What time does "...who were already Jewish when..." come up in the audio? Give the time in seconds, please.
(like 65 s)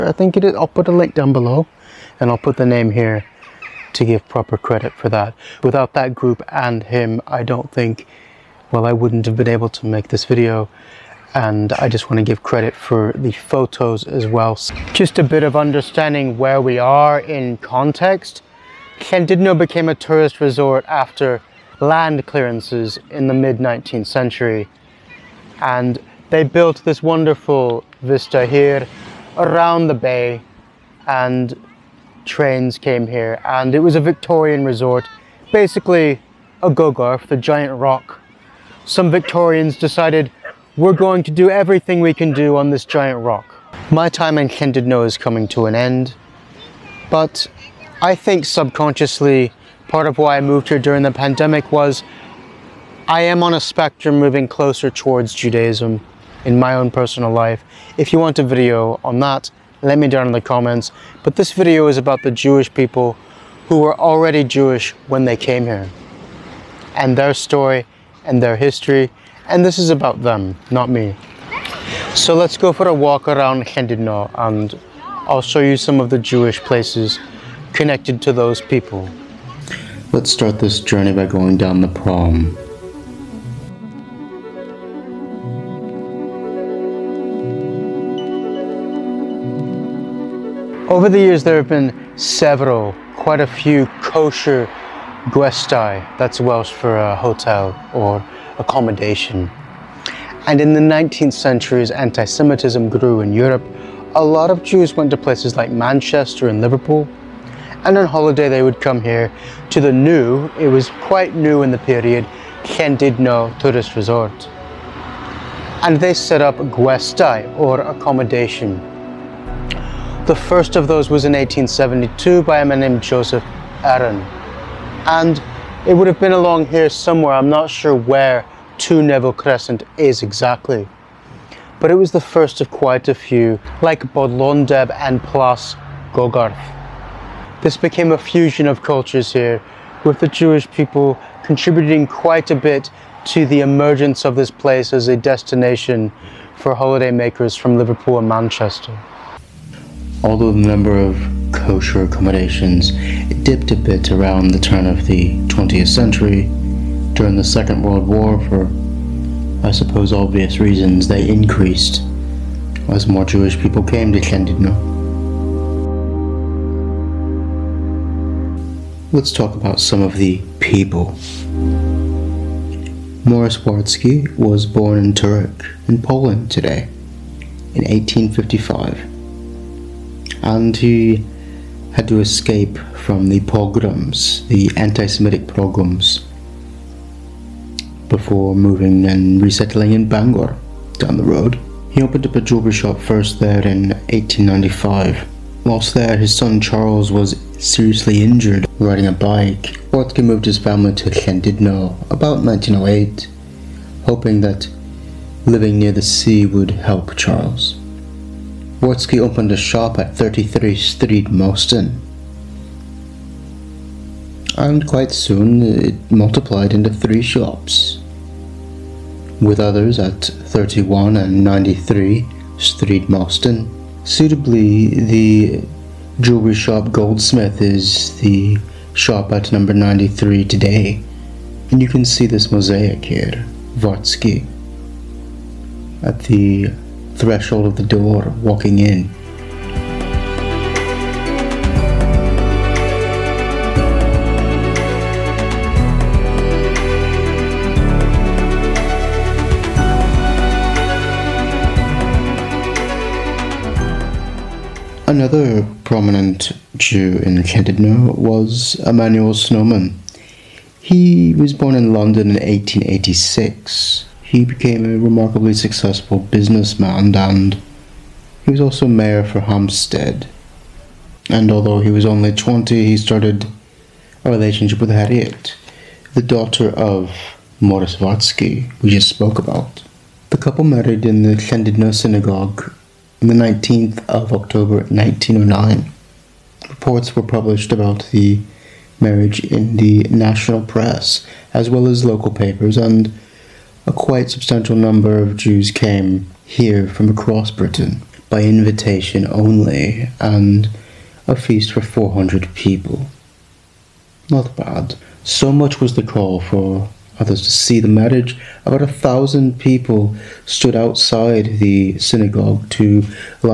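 63 s.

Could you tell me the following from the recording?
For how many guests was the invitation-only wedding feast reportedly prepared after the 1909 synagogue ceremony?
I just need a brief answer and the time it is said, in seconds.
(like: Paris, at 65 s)
400, at 301 s.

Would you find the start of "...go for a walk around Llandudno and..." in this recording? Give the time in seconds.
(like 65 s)
72 s.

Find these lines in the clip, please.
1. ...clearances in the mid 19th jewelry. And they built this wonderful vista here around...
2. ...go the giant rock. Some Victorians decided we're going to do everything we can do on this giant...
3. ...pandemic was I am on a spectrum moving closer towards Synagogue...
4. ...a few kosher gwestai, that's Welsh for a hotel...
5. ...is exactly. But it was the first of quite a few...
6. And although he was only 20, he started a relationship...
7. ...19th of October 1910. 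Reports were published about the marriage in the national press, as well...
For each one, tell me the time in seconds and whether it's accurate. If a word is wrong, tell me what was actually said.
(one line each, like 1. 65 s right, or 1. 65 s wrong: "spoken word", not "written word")
1. 22 s wrong: "century", not "jewelry"
2. 36 s right
3. 51 s wrong: "Judaism", not "Synagogue"
4. 93 s right
5. 129 s right
6. 271 s right
7. 283 s wrong: "1909", not "1910".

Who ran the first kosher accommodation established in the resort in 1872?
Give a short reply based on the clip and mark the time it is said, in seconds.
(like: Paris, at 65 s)
Joseph Aaron, at 123 s.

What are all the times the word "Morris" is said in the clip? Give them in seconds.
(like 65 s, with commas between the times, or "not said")
173 s, 277 s.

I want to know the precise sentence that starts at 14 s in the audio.
Just a bit of understanding where we are in context.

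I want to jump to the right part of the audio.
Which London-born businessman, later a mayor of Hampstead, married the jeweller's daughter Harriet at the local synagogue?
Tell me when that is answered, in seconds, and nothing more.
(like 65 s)
258 s.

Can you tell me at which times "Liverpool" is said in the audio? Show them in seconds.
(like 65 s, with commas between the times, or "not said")
106 s, 147 s.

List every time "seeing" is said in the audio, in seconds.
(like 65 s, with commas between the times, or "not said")
not said.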